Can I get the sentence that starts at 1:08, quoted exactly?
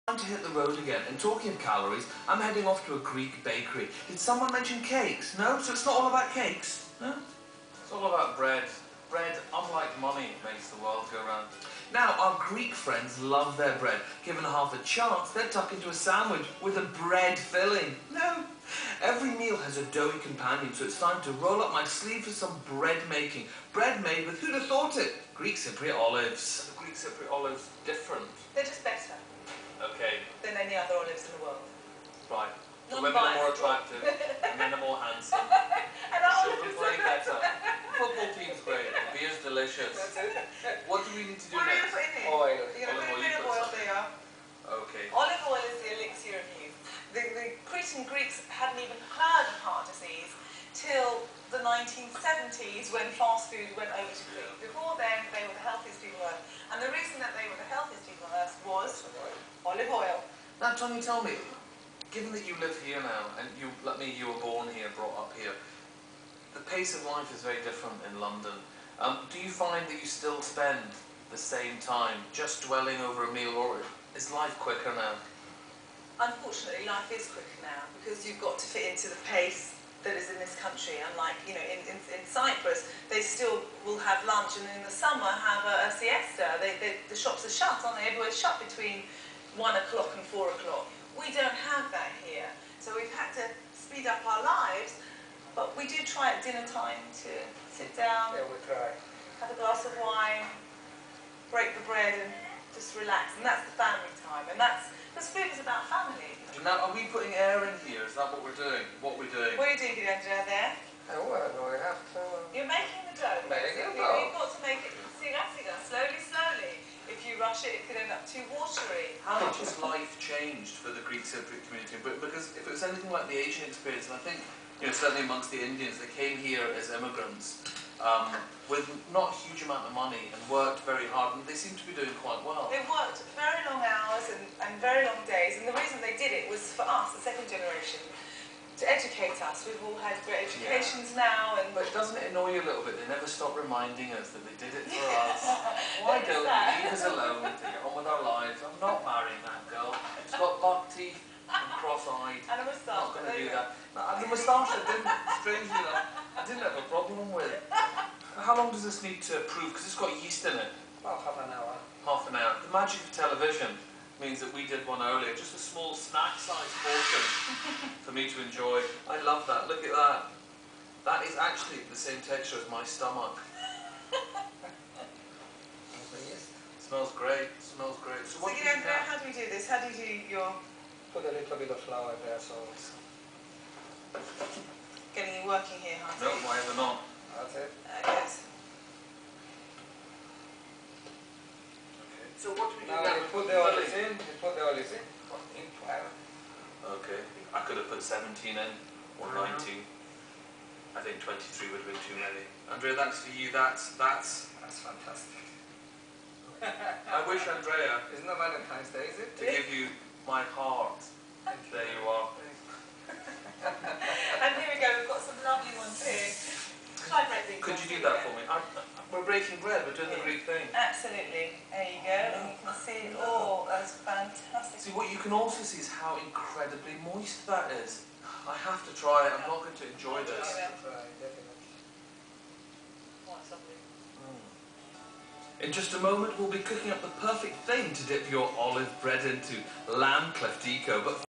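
Um, do you find that you still spend the same time just dwelling over a meal, or is life quicker now?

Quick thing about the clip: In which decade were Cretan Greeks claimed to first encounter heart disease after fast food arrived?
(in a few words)
1970s.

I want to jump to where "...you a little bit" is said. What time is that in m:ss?
2:22.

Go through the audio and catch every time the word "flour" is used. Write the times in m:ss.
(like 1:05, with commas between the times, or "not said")
3:01, 3:15.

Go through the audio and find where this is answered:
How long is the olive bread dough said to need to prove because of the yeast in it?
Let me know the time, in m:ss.
2:41.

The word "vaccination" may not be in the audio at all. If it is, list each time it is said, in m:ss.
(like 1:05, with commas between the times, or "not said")
not said.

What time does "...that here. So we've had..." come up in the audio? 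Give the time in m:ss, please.
1:31.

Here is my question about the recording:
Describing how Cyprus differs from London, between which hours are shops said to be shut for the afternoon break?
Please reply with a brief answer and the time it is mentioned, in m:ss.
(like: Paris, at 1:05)
1 to 4 o'clock, at 1:28.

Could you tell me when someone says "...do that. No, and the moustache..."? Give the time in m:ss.
2:33.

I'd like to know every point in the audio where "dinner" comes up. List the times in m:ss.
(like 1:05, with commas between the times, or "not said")
1:36.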